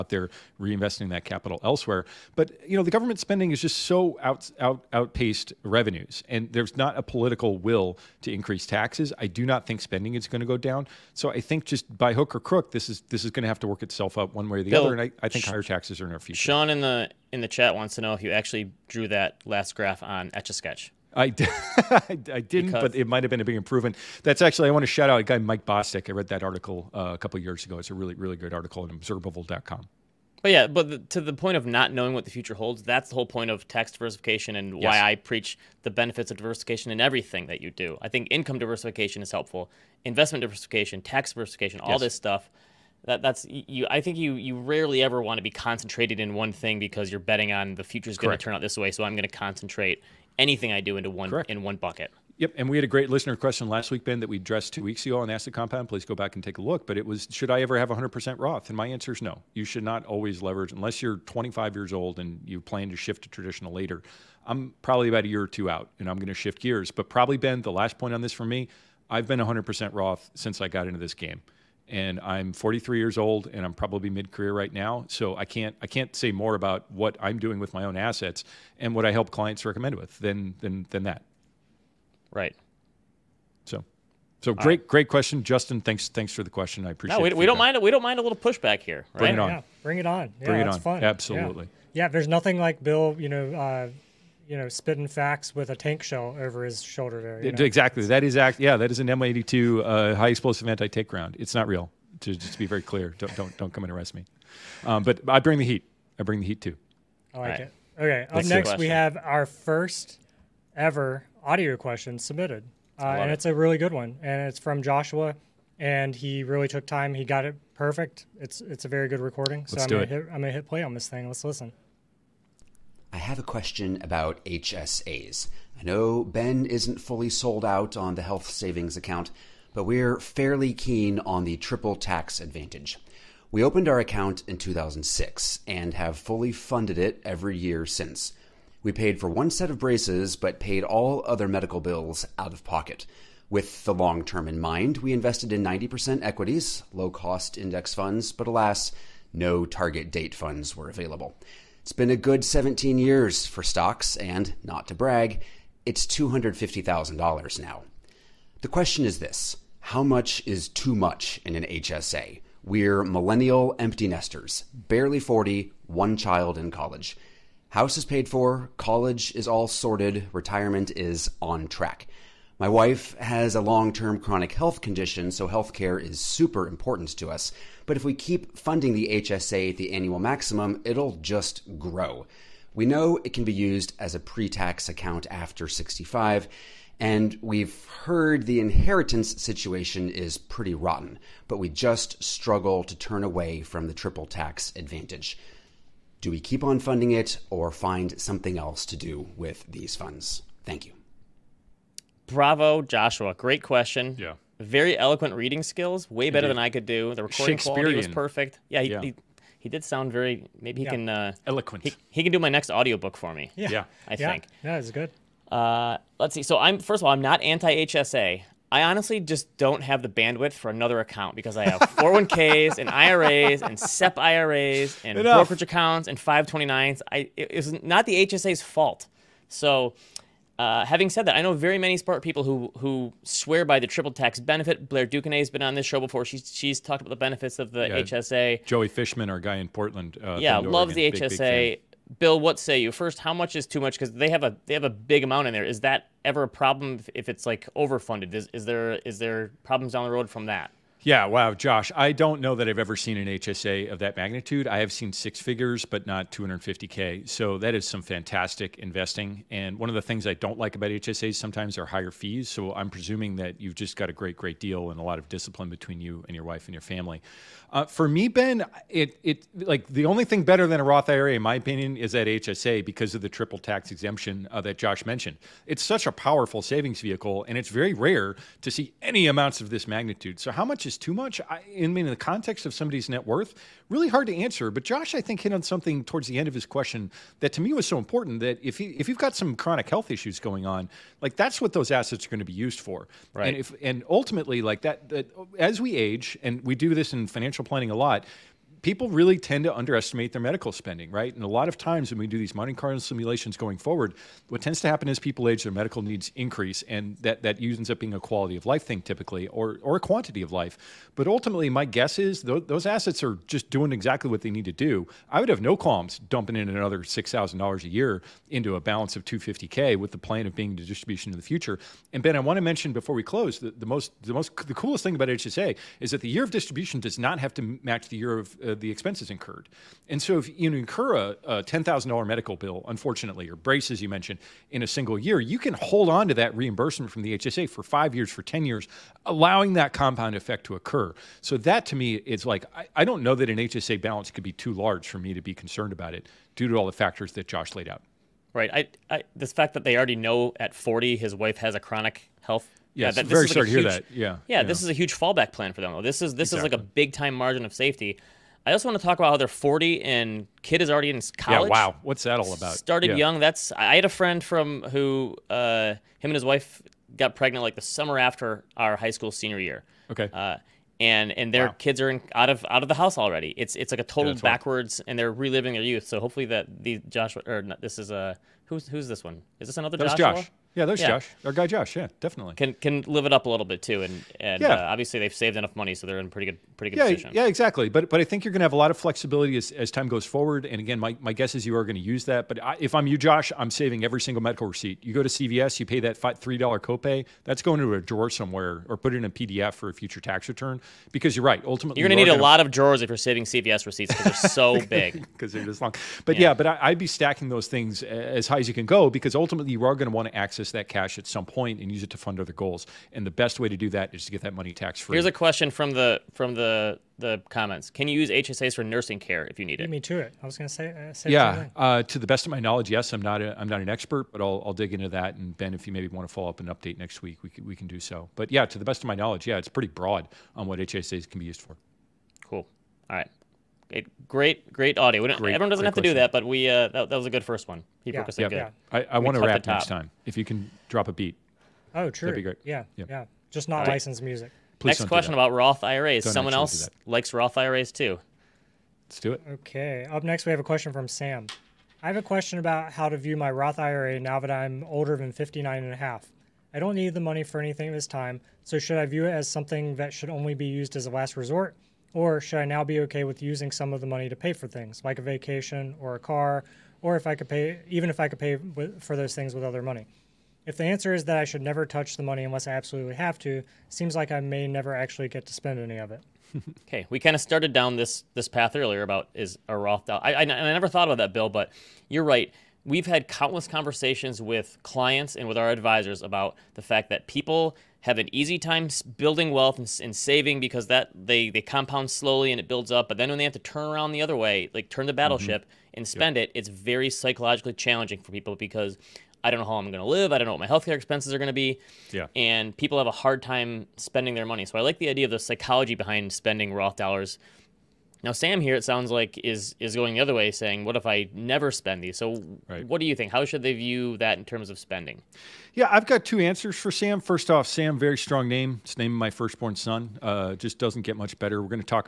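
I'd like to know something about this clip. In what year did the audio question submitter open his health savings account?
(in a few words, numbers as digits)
2006.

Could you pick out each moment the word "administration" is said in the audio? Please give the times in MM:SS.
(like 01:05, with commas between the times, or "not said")
not said.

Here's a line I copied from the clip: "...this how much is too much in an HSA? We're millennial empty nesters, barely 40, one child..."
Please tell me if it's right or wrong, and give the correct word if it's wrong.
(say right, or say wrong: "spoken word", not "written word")
right.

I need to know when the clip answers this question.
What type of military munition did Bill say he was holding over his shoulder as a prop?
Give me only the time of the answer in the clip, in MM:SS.
01:39.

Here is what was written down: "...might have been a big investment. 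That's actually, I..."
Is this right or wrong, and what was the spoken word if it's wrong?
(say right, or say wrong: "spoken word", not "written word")
wrong: "improvement", not "investment".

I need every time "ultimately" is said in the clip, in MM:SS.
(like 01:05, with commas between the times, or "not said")
04:54, 05:11, 06:41, 06:49.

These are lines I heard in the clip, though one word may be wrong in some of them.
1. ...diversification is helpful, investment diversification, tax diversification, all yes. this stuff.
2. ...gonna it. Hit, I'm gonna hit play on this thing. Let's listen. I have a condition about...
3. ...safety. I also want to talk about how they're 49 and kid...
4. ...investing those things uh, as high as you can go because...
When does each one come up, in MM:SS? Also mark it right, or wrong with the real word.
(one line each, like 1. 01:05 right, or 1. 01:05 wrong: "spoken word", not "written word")
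1. 00:38 right
2. 02:00 wrong: "question", not "condition"
3. 05:57 wrong: "40", not "49"
4. 06:47 wrong: "stacking", not "investing".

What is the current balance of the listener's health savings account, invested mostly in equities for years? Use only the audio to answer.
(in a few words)
$250,000.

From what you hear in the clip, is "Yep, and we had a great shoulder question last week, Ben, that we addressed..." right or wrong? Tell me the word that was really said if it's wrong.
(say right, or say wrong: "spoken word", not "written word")
wrong: "listener", not "shoulder".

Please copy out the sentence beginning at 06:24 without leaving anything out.
uh, obviously they've saved enough money, so they're in pretty good pretty good yeah, position.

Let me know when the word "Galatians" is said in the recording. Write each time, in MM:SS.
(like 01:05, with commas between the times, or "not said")
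not said.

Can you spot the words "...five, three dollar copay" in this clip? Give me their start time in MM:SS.
06:36.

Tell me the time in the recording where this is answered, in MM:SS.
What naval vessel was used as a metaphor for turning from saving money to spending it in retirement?
08:15.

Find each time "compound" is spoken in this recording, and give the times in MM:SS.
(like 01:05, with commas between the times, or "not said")
00:55, 05:39, 08:11.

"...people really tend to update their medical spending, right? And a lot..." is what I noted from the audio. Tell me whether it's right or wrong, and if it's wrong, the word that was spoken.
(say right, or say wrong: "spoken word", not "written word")
wrong: "underestimate", not "update".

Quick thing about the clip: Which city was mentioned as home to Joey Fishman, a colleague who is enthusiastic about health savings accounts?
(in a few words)
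Portland.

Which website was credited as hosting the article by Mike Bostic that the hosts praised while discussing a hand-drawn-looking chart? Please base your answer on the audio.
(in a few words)
observable.com.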